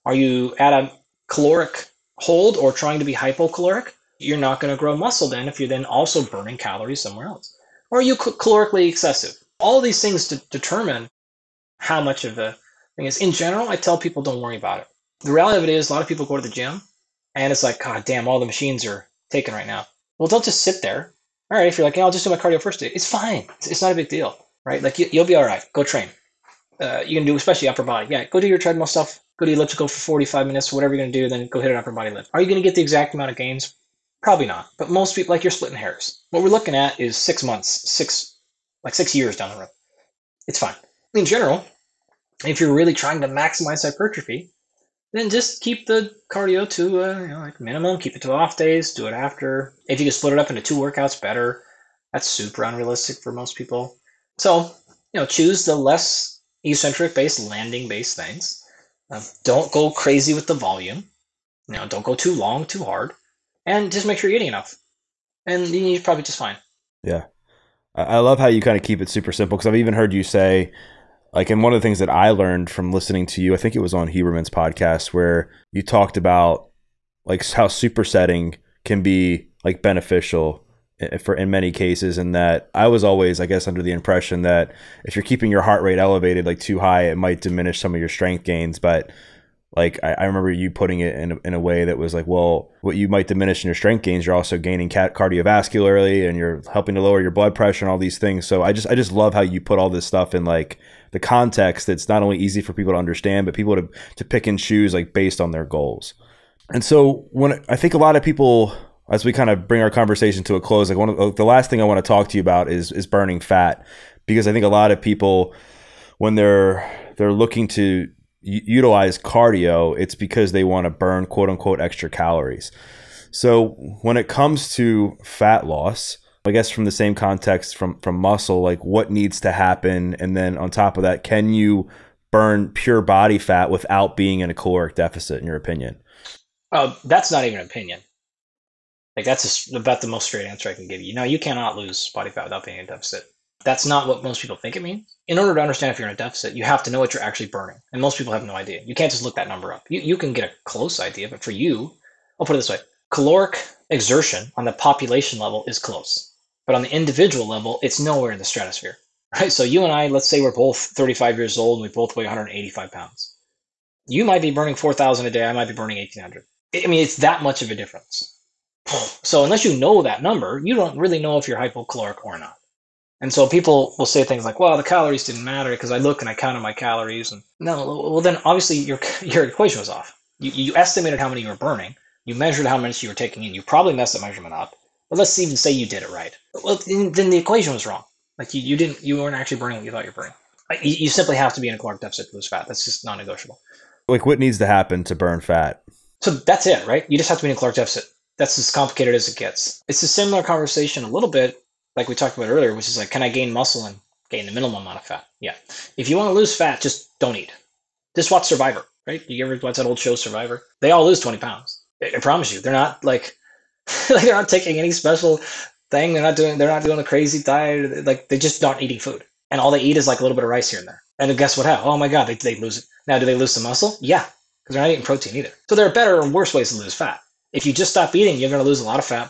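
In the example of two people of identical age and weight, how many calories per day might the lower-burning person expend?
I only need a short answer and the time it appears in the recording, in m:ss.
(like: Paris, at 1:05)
1,800, at 2:45.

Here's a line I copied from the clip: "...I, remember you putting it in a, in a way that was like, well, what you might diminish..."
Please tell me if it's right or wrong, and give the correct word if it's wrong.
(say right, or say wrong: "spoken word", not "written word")
right.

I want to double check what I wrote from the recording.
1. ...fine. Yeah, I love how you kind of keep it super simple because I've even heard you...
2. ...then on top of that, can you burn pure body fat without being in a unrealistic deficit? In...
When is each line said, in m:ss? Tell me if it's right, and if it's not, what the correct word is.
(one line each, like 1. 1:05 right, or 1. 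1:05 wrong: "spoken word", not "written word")
1. 1:06 right
2. 2:10 wrong: "caloric", not "unrealistic".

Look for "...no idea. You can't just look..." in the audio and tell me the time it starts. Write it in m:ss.
2:28.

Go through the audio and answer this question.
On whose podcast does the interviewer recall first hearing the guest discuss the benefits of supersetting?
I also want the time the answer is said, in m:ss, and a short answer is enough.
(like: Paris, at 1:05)
Huberman, at 1:14.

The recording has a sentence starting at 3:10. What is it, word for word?
You, you simply have to be in a caloric deficit to lose fat.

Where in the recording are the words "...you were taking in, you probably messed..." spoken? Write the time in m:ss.
3:03.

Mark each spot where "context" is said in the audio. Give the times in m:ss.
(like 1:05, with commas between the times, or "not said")
1:41, 2:07.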